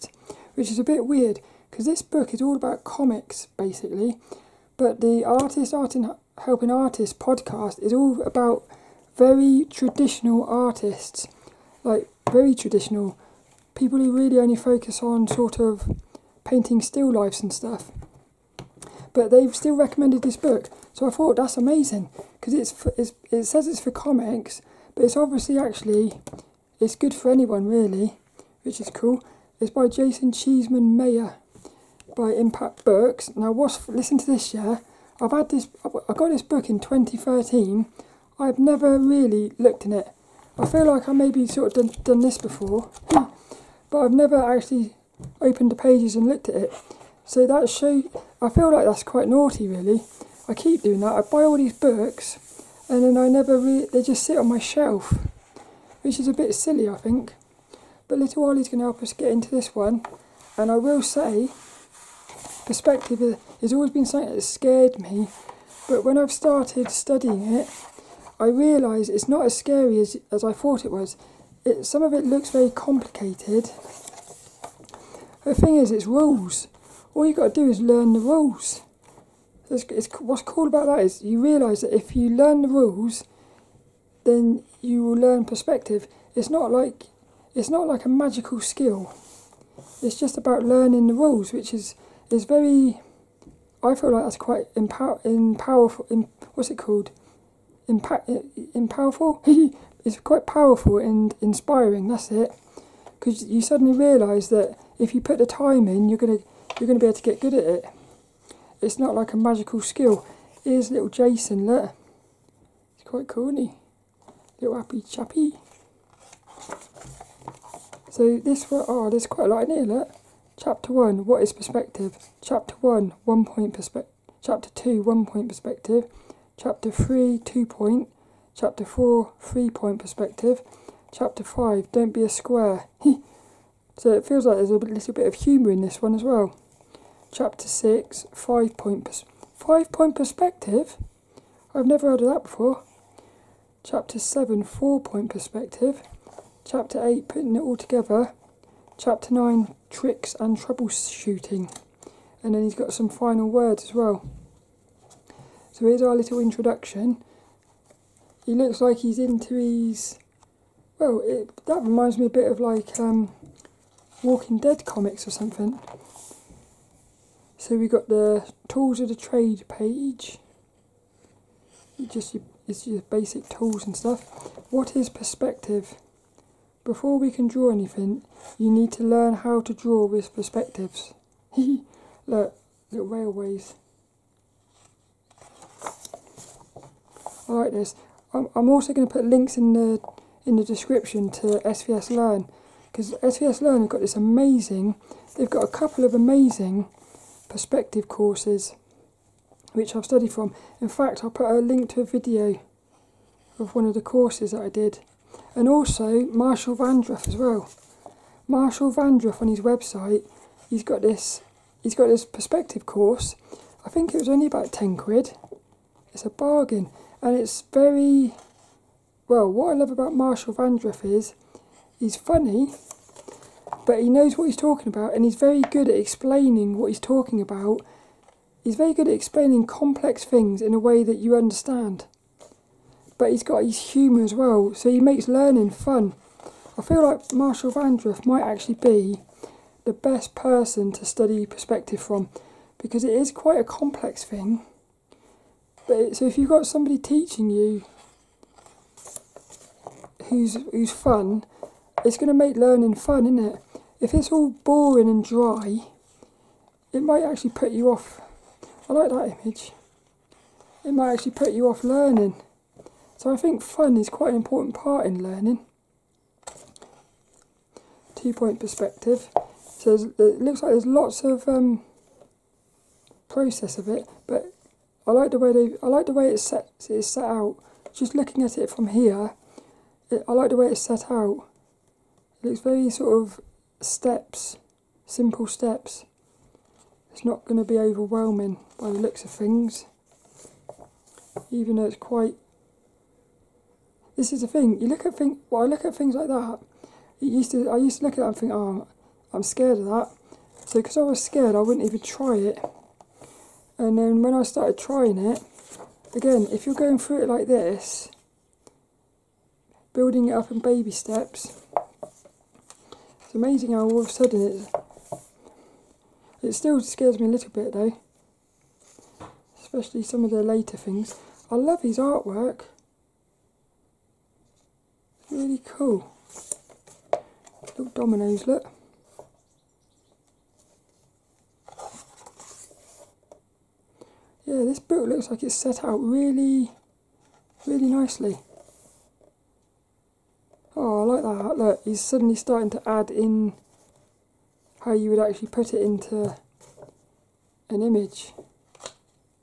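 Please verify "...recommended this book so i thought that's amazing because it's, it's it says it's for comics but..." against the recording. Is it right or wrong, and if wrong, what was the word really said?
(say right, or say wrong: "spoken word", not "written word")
right.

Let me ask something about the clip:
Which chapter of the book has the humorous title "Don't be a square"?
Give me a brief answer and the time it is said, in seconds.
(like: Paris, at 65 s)
Chapter 5, at 131 s.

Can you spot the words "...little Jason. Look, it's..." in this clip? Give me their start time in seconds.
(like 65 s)
110 s.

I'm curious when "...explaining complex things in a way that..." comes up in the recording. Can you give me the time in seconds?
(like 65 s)
229 s.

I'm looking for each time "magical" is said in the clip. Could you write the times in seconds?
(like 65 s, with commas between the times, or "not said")
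88 s, 109 s.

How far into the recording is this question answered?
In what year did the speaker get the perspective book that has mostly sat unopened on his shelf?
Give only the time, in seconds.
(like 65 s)
36 s.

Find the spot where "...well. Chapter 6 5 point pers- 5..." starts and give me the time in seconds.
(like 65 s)
136 s.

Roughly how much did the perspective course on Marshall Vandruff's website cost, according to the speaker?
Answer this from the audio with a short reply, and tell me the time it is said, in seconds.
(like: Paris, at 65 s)
10 quid, at 214 s.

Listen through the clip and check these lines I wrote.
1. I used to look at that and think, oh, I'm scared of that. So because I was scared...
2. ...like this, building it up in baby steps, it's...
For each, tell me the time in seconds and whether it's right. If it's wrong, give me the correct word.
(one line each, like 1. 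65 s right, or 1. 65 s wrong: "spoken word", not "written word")
1. 297 s right
2. 307 s right.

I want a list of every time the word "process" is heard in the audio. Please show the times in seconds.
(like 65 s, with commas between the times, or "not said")
273 s.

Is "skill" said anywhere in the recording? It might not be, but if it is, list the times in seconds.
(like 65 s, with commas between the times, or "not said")
88 s, 109 s.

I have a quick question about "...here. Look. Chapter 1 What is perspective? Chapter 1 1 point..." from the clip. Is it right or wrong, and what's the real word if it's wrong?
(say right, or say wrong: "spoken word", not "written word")
right.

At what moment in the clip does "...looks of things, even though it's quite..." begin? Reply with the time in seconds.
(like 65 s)
288 s.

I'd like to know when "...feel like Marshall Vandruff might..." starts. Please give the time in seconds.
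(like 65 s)
236 s.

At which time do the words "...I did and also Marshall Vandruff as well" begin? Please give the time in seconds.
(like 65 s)
204 s.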